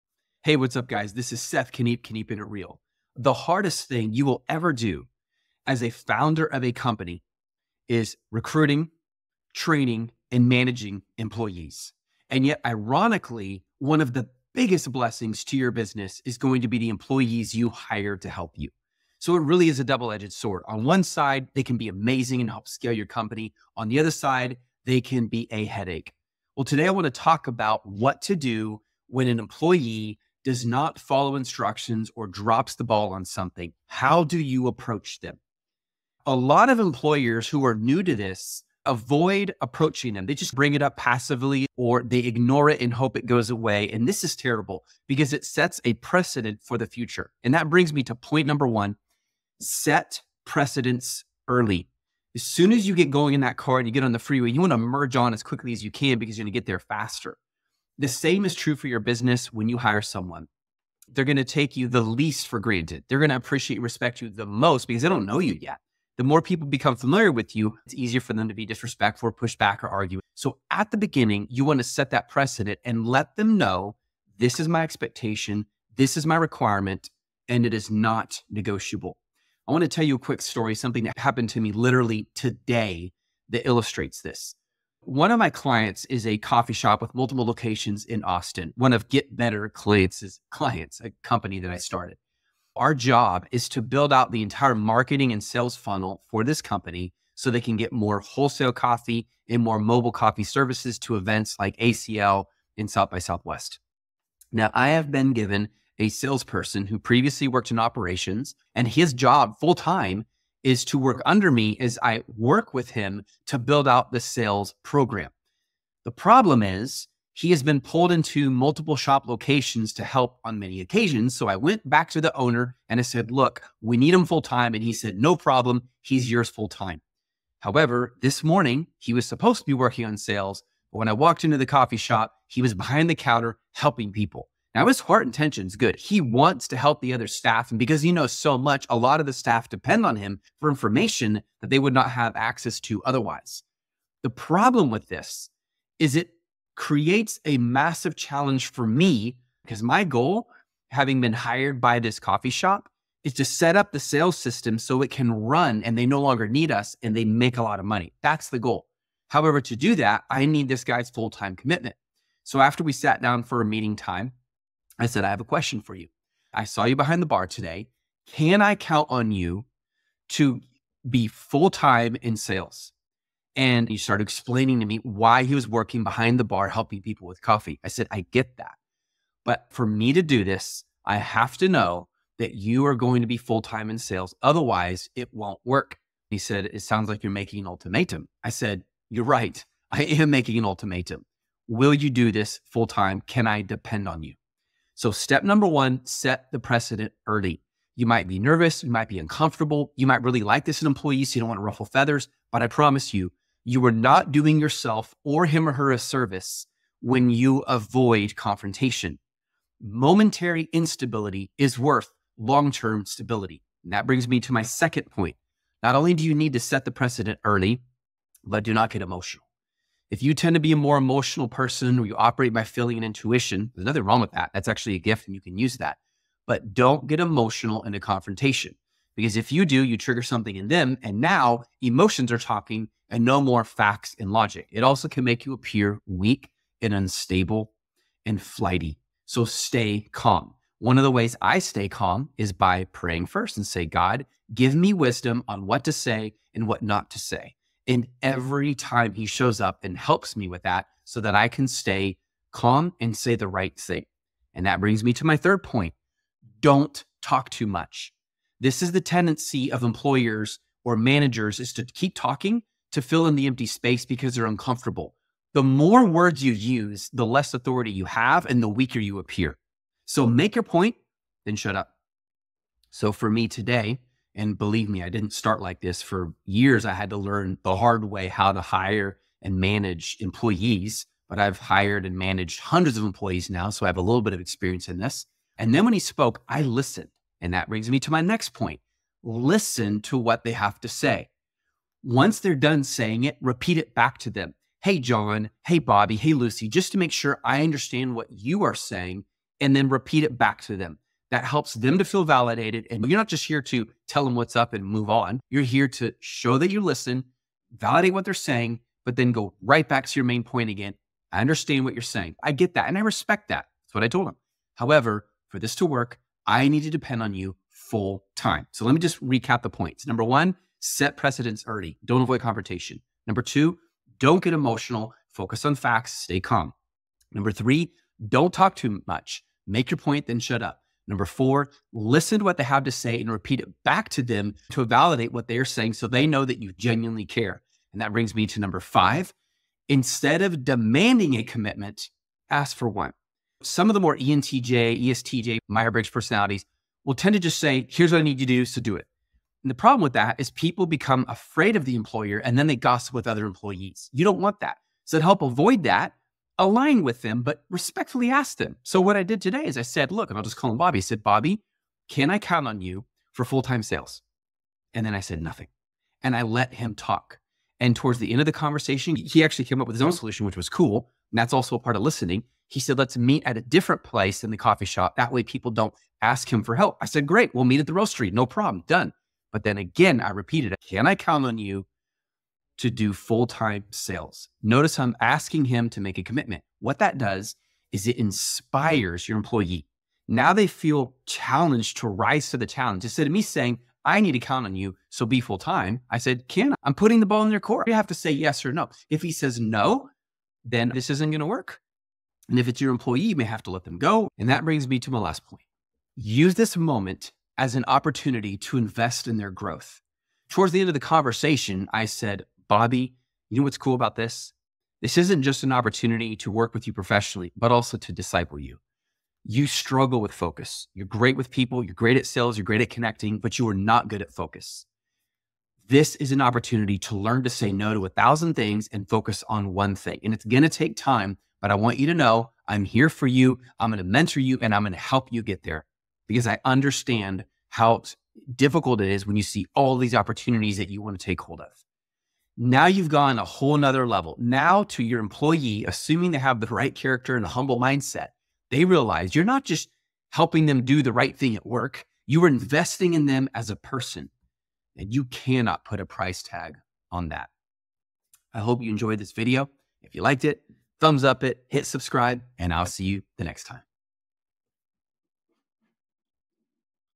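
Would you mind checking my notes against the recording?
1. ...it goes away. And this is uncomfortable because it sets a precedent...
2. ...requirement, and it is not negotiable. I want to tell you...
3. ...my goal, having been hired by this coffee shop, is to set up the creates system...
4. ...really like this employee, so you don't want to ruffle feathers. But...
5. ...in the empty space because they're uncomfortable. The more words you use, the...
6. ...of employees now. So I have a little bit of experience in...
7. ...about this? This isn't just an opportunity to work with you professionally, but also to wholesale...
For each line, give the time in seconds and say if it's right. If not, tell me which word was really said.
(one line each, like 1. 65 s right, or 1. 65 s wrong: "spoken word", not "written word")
1. 43 s wrong: "terrible", not "uncomfortable"
2. 76 s right
3. 149 s wrong: "sales", not "creates"
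4. 200 s right
5. 263 s right
6. 282 s right
7. 413 s wrong: "disciple", not "wholesale".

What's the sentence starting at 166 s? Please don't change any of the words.
I saw you behind the bar today.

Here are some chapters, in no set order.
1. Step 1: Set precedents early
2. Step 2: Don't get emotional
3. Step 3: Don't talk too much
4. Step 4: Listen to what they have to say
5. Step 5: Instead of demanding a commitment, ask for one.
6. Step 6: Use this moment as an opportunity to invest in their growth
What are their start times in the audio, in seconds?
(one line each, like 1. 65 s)
1. 49 s
2. 215 s
3. 256 s
4. 289 s
5. 338 s
6. 406 s.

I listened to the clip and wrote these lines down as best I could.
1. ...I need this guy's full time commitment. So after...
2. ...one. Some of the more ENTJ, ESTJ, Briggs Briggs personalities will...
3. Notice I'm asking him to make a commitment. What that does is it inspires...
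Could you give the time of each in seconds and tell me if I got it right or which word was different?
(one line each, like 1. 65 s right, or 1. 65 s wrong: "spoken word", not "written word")
1. 160 s right
2. 342 s wrong: "Meyer", not "Briggs"
3. 384 s right.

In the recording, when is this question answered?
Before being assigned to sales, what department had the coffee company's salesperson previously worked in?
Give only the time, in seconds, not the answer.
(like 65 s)
107 s.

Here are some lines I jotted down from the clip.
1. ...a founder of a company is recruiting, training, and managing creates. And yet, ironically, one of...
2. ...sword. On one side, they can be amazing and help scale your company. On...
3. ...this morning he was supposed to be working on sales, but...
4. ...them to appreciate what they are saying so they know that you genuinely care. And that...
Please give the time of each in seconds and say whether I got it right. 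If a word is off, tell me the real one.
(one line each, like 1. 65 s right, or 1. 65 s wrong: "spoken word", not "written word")
1. 5 s wrong: "employees", not "creates"
2. 20 s right
3. 128 s right
4. 334 s wrong: "validate", not "appreciate".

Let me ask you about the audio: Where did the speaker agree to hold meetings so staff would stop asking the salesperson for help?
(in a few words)
The roastery.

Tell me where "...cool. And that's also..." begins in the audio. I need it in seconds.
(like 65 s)
370 s.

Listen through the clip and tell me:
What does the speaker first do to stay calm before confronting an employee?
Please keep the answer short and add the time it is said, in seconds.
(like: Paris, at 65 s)
Praying, at 242 s.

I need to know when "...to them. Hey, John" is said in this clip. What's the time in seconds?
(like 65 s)
294 s.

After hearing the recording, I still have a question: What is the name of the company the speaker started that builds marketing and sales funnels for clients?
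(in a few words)
Get Better.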